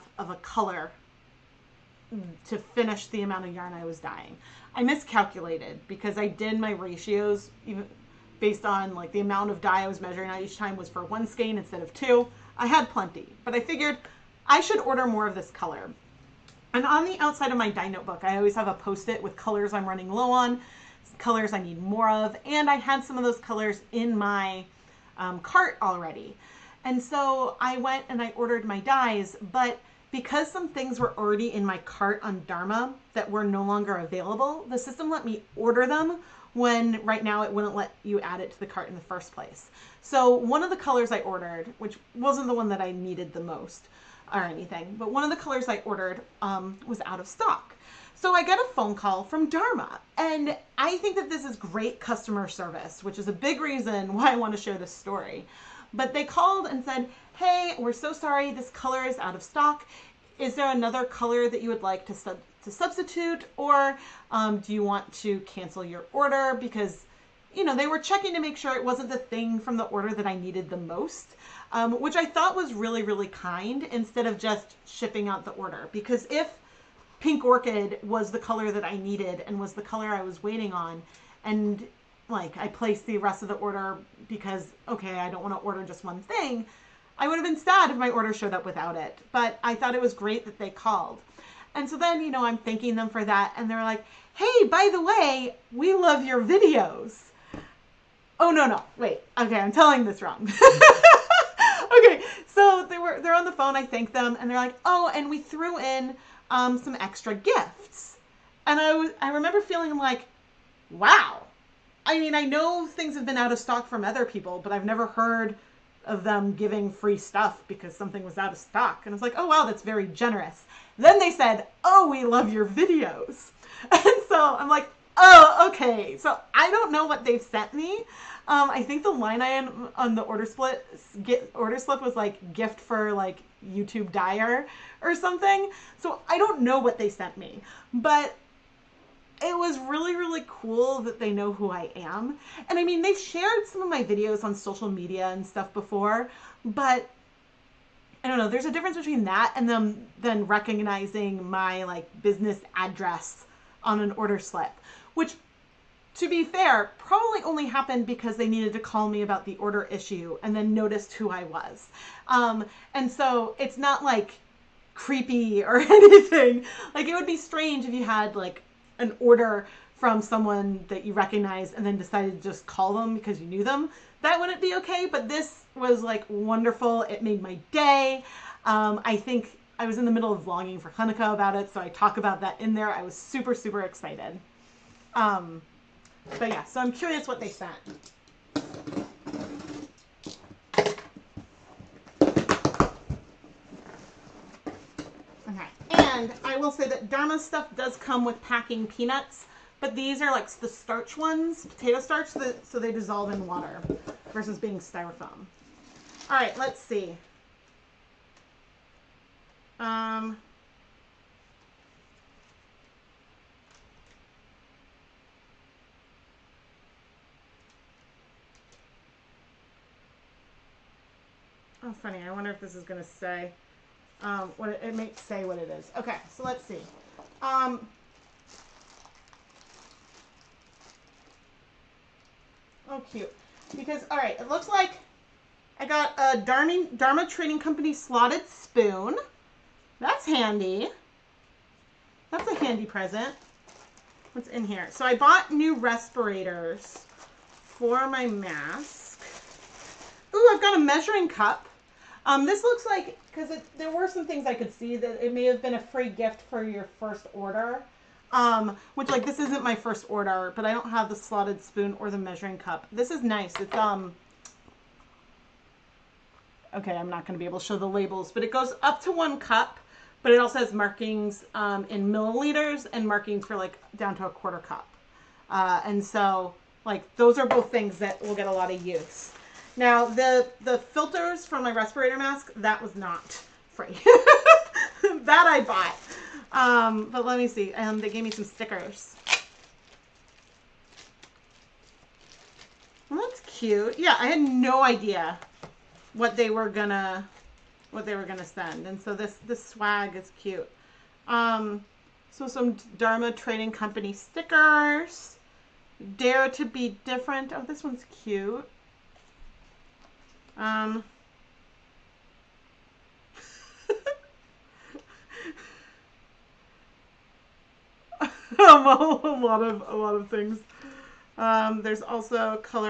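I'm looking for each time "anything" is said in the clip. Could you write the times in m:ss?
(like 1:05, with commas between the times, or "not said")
0:44, 2:45.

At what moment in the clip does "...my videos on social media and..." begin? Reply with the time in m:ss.
2:23.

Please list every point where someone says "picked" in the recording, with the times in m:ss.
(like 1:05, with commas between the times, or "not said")
not said.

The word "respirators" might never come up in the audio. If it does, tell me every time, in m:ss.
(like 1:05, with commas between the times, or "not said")
4:05, 4:41.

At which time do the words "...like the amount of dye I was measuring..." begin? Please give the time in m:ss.
0:08.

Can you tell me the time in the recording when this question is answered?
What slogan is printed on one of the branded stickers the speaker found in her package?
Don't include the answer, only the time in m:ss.
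5:06.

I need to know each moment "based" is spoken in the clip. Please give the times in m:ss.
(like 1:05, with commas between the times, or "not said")
0:08.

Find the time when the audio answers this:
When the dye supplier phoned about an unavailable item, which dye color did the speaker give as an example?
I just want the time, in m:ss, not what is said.
1:17.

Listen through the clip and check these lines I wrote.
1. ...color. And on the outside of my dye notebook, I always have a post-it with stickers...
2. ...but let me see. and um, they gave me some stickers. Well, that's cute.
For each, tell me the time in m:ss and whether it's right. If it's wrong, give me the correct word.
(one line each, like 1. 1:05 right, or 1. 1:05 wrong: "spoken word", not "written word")
1. 0:15 wrong: "colors", not "stickers"
2. 4:47 right.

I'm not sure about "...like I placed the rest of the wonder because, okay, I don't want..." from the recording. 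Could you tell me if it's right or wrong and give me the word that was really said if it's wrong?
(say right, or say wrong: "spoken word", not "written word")
wrong: "order", not "wonder".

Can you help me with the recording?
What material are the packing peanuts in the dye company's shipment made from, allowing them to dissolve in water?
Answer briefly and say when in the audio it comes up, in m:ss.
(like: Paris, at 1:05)
potato starch, at 3:21.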